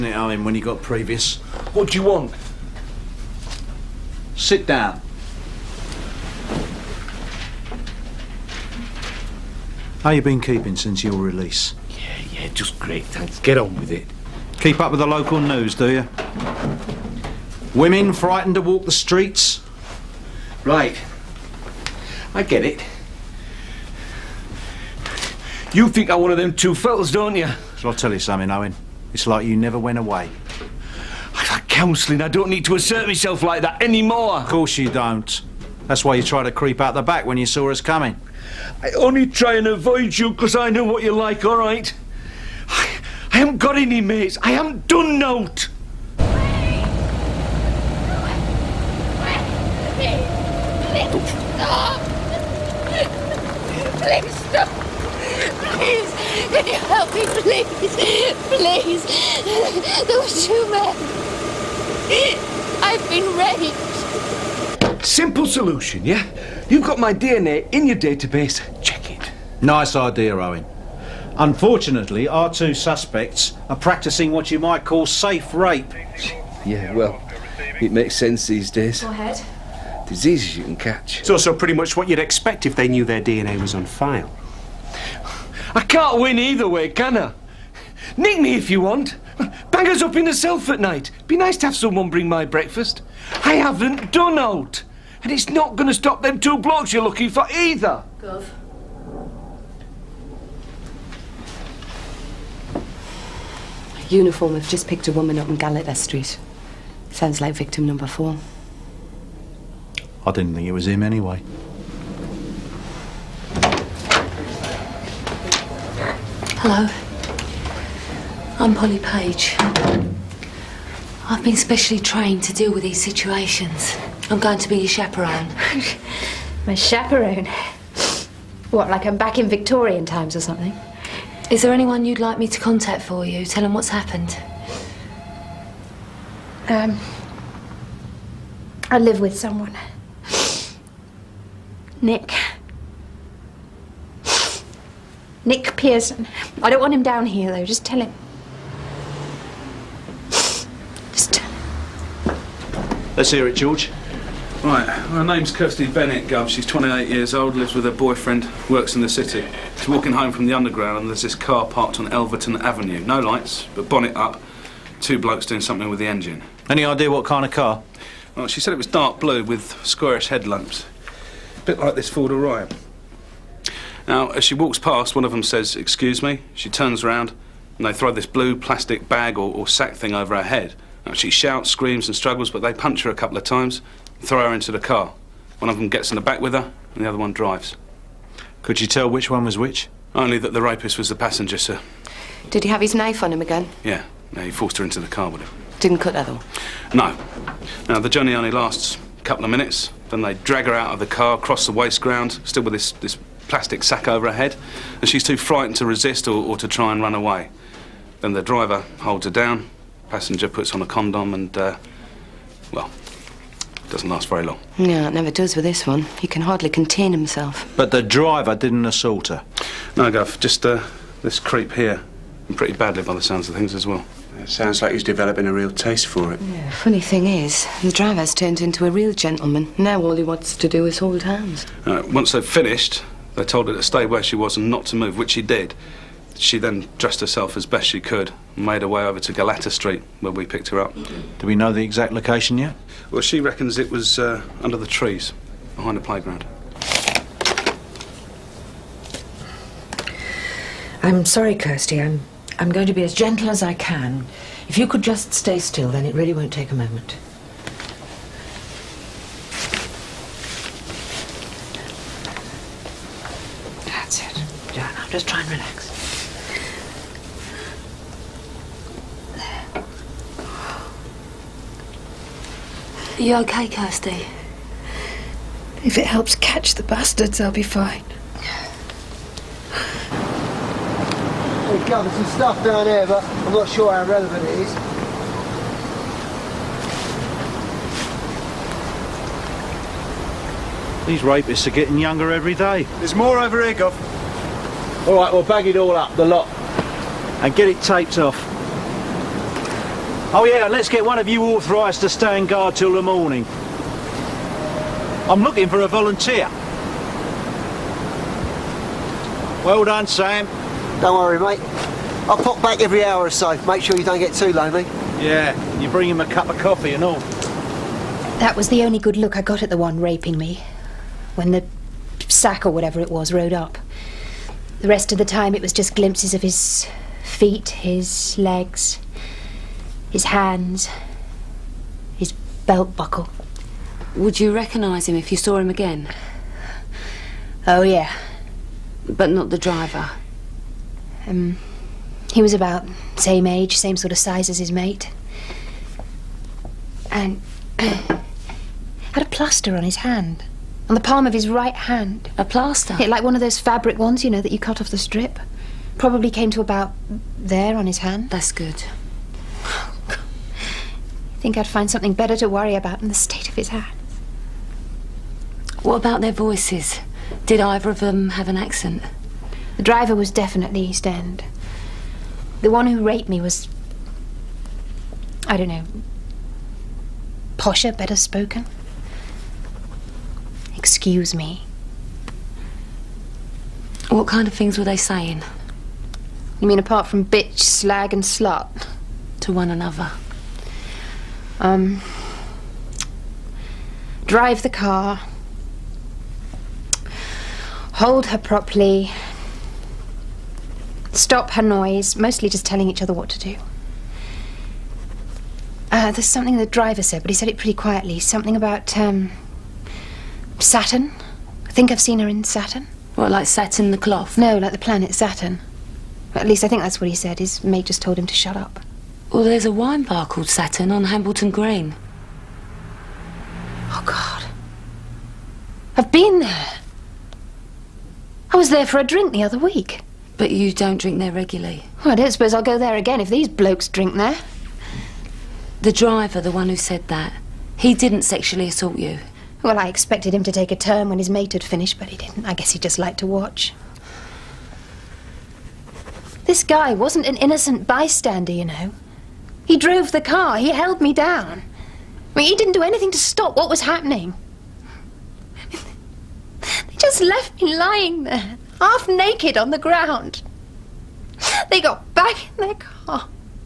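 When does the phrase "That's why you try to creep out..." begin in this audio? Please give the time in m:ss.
0:35.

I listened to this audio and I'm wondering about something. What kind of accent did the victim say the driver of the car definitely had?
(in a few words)
East End.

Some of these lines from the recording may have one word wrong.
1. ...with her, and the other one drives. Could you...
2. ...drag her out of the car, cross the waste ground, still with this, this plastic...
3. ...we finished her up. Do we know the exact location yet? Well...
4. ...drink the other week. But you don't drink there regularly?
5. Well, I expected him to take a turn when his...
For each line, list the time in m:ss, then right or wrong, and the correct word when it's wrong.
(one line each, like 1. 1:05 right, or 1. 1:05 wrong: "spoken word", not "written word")
1. 3:06 right
2. 3:20 right
3. 4:00 wrong: "picked", not "finished"
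4. 7:09 right
5. 7:19 right.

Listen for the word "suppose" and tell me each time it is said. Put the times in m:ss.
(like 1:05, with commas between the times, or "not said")
7:12.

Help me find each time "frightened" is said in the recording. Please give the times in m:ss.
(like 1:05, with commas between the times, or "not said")
0:18, 3:25.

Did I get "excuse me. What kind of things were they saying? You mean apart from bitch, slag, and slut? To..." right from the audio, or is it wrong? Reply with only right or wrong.
right.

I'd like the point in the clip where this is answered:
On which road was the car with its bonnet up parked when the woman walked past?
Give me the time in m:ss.
2:42.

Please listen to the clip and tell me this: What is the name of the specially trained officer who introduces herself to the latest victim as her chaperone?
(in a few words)
Polly Page.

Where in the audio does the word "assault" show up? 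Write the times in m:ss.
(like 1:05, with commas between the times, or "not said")
3:38, 7:18.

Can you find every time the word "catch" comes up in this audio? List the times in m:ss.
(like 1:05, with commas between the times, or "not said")
1:20, 4:36.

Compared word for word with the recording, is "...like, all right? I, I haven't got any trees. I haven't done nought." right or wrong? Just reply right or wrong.
wrong.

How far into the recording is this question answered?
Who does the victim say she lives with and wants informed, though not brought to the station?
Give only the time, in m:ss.
2:25.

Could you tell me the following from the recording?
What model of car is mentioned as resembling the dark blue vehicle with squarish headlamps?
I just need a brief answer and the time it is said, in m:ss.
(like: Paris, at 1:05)
Ford Orion, at 2:52.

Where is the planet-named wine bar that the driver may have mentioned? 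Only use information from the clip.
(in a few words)
Hambleton Green.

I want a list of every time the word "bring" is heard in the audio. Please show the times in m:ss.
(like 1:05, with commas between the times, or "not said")
1:32, 5:15.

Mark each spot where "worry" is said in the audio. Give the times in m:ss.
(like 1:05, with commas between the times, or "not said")
5:11, 6:02.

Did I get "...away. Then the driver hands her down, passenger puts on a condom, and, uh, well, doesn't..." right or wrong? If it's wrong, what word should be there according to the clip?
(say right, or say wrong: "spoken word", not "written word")
wrong: "holds", not "hands".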